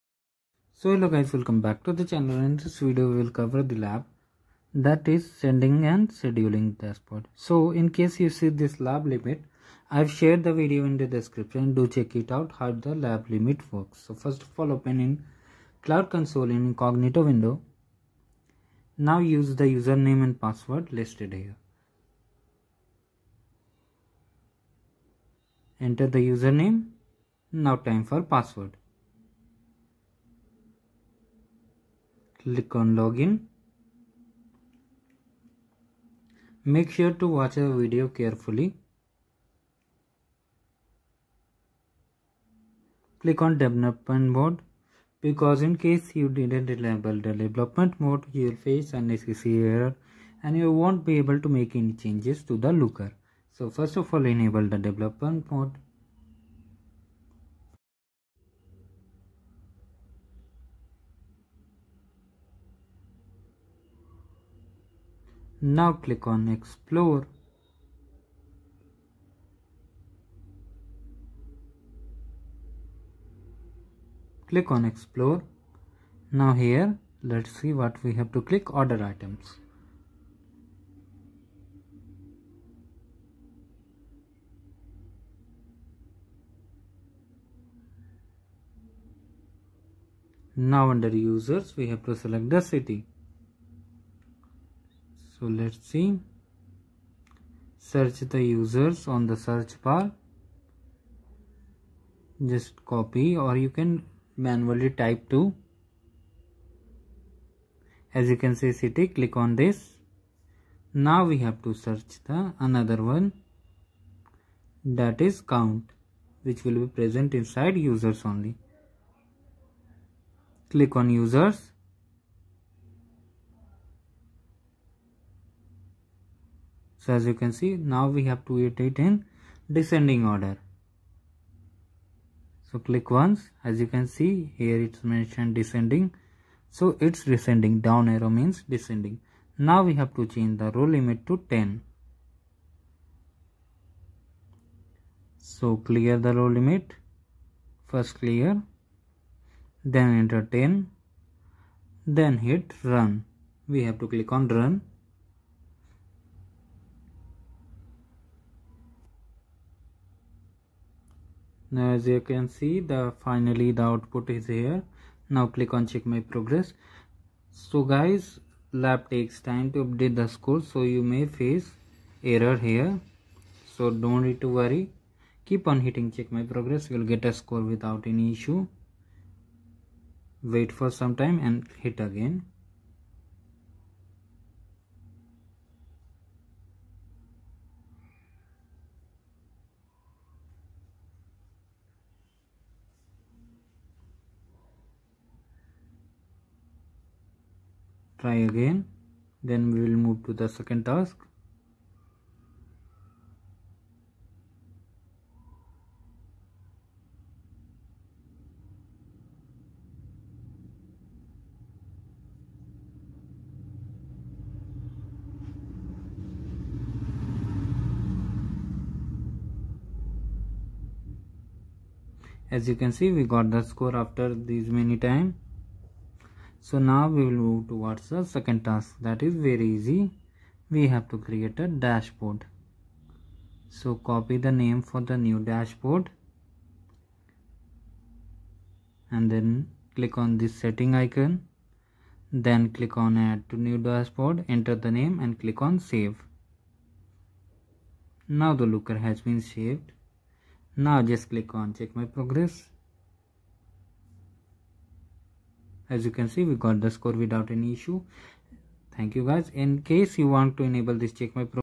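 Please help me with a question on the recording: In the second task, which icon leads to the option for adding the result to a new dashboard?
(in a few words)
Setting icon.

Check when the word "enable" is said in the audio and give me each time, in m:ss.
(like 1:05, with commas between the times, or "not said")
0:46, 0:54, 4:20.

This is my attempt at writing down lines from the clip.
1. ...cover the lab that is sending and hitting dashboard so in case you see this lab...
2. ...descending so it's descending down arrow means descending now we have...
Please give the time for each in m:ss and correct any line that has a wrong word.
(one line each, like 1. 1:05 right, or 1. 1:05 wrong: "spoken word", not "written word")
1. 0:03 wrong: "scheduling", not "hitting"
2. 2:15 right.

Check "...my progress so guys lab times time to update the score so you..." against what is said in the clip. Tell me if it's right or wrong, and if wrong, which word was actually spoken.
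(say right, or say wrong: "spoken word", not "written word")
wrong: "takes", not "times".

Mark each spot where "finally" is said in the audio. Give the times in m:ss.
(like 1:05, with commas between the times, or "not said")
2:43.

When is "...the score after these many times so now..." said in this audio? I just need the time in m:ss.
3:43.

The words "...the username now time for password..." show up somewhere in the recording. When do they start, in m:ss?
0:26.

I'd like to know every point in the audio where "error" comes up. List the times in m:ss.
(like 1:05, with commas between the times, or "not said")
0:49, 2:52.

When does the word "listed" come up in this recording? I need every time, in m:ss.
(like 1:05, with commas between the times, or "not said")
0:21.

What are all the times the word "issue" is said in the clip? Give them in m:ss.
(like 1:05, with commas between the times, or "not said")
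2:58, 4:17.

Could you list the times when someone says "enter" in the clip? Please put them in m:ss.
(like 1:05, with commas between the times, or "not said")
0:25, 2:30, 4:04.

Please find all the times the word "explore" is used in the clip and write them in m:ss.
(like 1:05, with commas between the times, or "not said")
1:06, 1:14.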